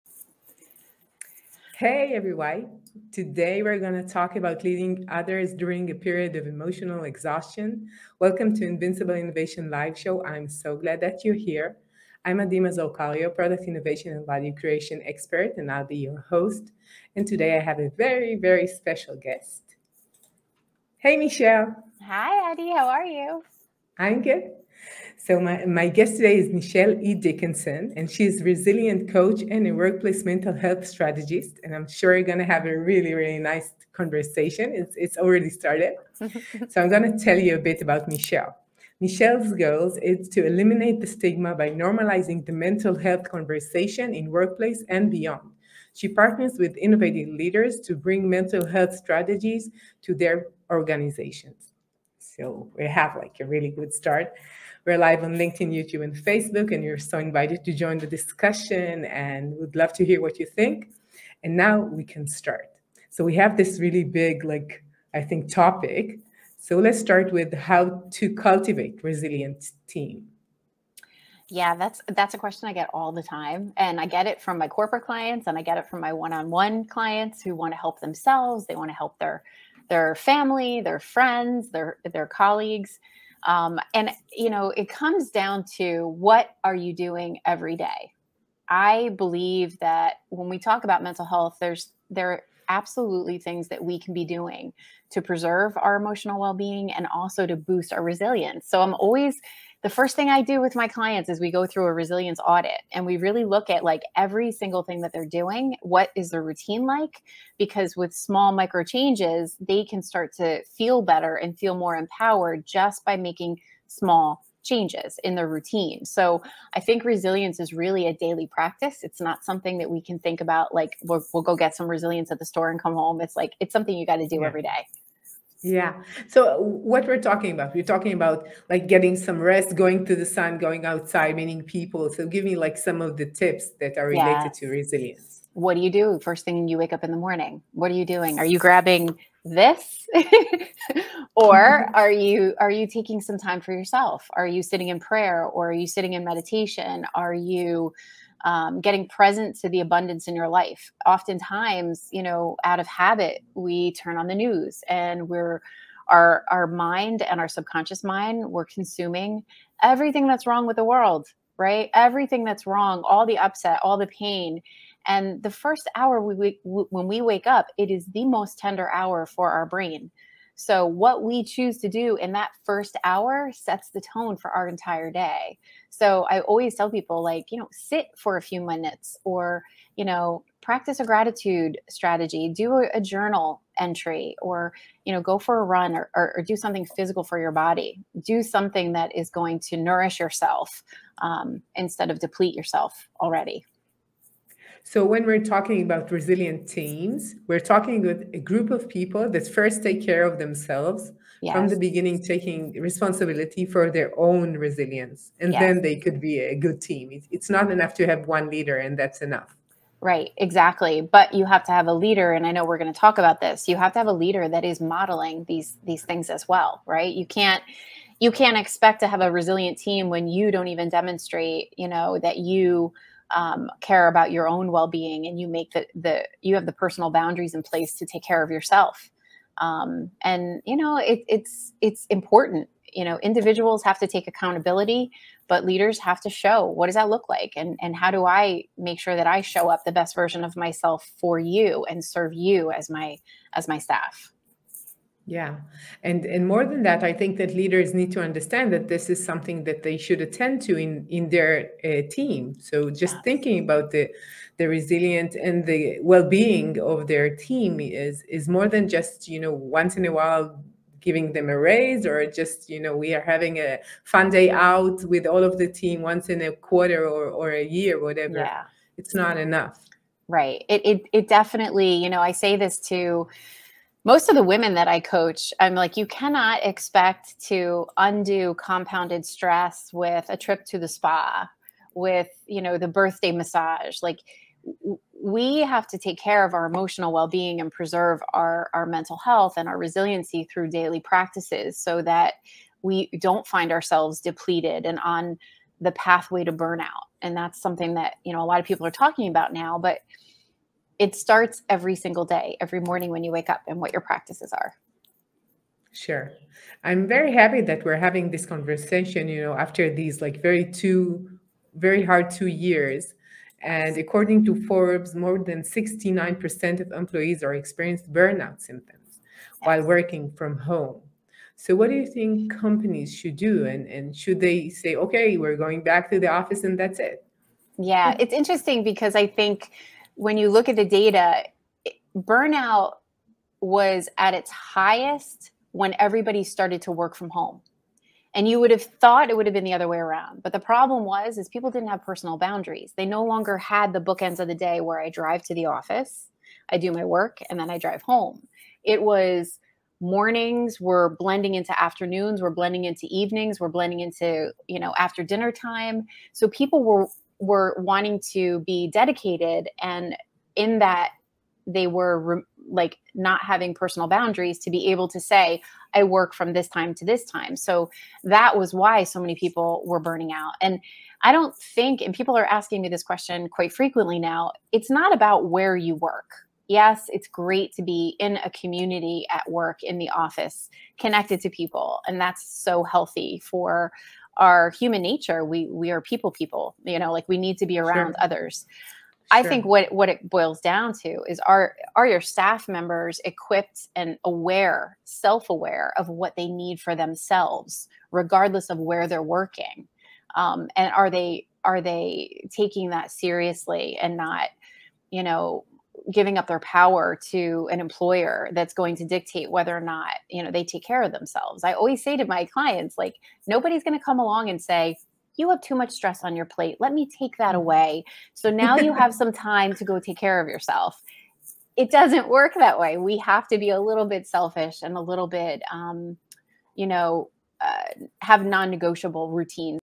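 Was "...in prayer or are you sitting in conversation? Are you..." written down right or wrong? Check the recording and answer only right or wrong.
wrong.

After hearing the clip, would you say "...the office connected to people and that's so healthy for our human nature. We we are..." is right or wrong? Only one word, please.
right.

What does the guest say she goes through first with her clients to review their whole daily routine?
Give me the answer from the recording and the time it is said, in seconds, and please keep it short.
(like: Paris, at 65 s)
A resilience audit, at 101 s.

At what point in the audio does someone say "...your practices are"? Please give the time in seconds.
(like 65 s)
303 s.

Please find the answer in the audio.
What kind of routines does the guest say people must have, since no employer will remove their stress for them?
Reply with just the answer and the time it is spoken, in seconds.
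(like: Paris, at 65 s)
Non-negotiable routines, at 428 s.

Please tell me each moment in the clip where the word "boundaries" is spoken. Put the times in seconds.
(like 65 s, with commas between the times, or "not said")
227 s, 342 s, 364 s.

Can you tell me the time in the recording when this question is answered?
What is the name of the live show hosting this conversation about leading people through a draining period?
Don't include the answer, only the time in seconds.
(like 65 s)
8 s.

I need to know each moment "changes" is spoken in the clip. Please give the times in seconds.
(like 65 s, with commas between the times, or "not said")
108 s, 114 s.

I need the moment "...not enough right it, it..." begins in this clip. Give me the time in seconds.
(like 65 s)
269 s.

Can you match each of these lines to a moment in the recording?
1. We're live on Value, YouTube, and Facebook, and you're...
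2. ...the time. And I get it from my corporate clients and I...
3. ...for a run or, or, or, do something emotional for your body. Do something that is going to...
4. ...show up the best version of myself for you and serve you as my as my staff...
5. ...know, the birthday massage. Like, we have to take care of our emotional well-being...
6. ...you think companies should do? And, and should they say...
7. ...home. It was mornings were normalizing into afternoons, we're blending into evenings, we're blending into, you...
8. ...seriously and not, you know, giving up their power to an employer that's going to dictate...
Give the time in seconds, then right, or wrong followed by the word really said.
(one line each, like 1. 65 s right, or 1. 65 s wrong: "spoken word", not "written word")
1. 54 s wrong: "LinkedIn", not "Value"
2. 73 s right
3. 185 s wrong: "physical", not "emotional"
4. 239 s right
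5. 282 s right
6. 321 s right
7. 348 s wrong: "blending", not "normalizing"
8. 403 s right.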